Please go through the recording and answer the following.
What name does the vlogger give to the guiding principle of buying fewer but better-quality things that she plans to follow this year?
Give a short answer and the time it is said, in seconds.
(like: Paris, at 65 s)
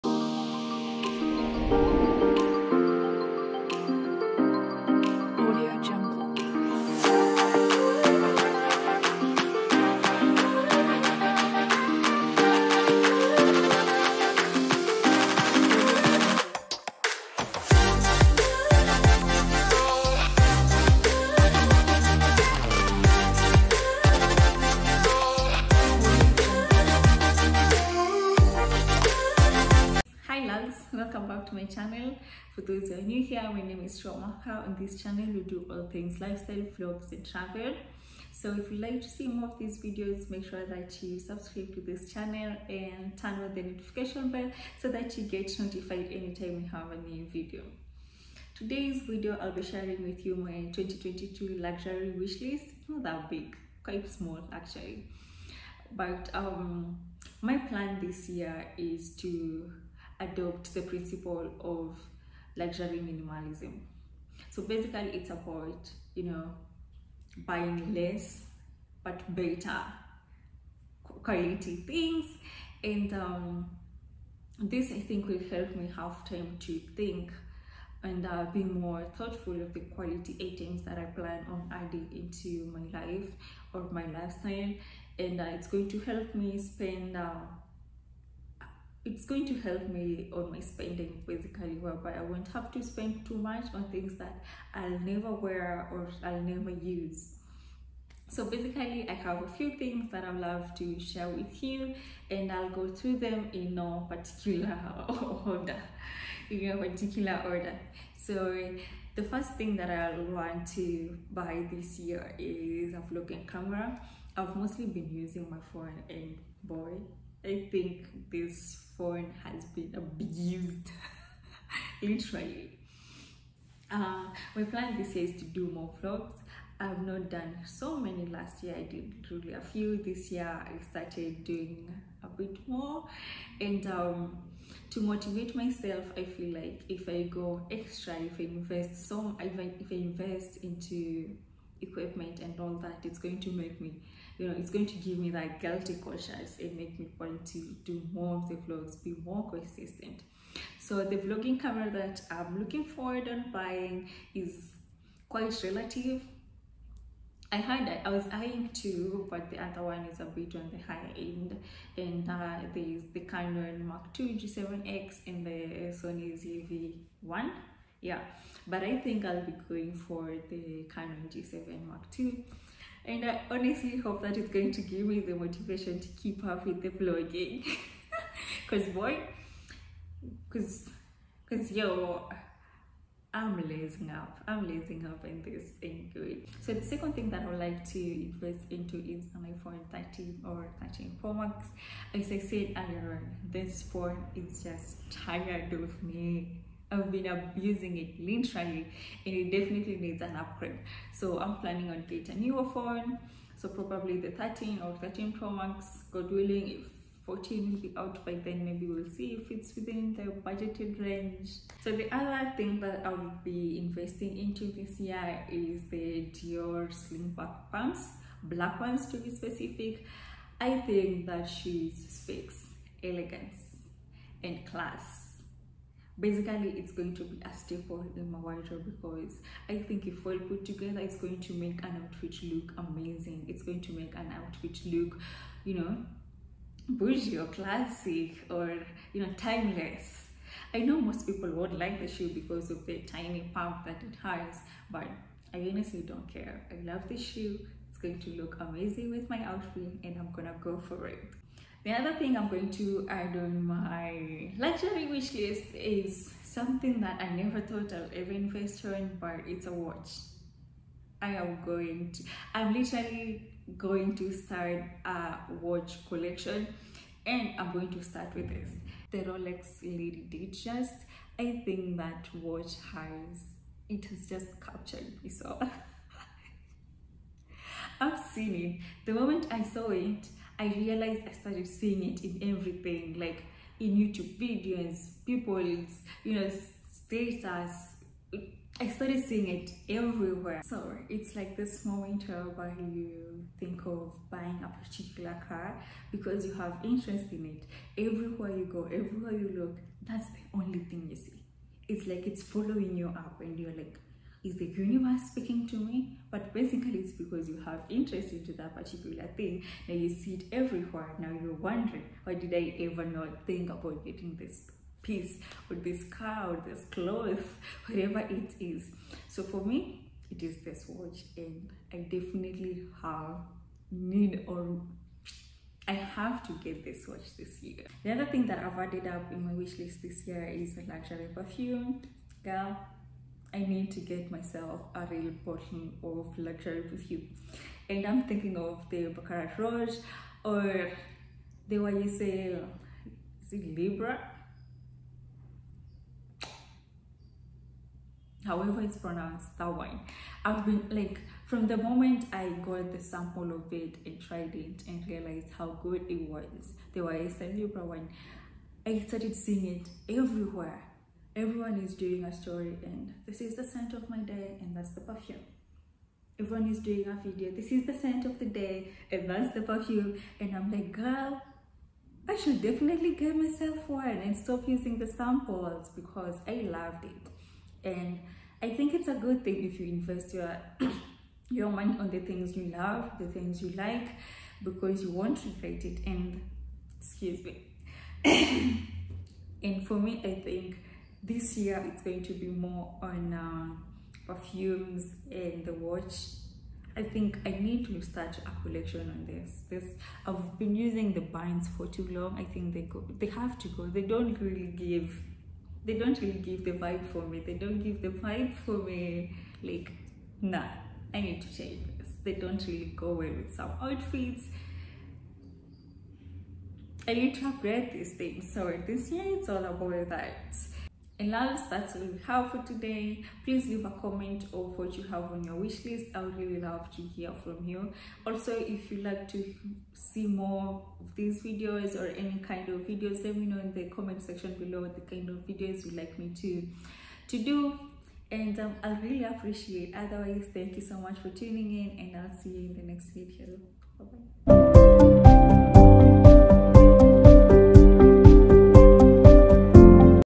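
luxury minimalism, at 62 s.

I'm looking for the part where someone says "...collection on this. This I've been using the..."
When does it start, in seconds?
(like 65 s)
398 s.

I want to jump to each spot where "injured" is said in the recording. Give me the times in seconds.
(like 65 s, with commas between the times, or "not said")
not said.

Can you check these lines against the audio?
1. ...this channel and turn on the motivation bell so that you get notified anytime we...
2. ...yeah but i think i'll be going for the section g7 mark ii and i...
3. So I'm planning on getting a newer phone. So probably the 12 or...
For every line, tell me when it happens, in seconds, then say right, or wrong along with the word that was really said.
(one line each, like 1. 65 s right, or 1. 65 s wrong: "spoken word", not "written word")
1. 41 s wrong: "notification", not "motivation"
2. 168 s wrong: "canon", not "section"
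3. 201 s wrong: "13", not "12".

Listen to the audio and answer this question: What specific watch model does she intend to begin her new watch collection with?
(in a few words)
Rolex Lady Datejust.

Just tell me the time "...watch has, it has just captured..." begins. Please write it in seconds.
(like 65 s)
272 s.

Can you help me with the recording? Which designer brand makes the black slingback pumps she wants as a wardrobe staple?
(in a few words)
Dior.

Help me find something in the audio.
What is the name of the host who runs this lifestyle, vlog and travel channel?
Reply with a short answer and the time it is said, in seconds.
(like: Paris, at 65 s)
Sure Mwaka, at 33 s.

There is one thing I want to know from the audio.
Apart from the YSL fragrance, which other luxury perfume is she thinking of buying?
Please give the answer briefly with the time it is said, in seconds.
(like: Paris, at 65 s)
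Baccarat Rouge, at 339 s.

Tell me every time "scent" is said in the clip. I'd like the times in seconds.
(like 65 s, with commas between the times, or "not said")
363 s, 367 s.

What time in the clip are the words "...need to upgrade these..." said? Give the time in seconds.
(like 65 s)
417 s.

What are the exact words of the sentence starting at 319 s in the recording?
So for me, it is this watch, and I definitely have need or I have to get this watch this year.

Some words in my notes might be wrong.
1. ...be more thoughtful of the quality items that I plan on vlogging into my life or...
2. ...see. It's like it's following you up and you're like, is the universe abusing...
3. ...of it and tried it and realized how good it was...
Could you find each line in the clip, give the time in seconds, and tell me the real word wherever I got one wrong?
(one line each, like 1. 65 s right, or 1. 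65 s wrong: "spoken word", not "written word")
1. 78 s wrong: "adding", not "vlogging"
2. 301 s wrong: "speaking", not "abusing"
3. 353 s right.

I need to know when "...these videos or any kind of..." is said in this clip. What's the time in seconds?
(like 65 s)
431 s.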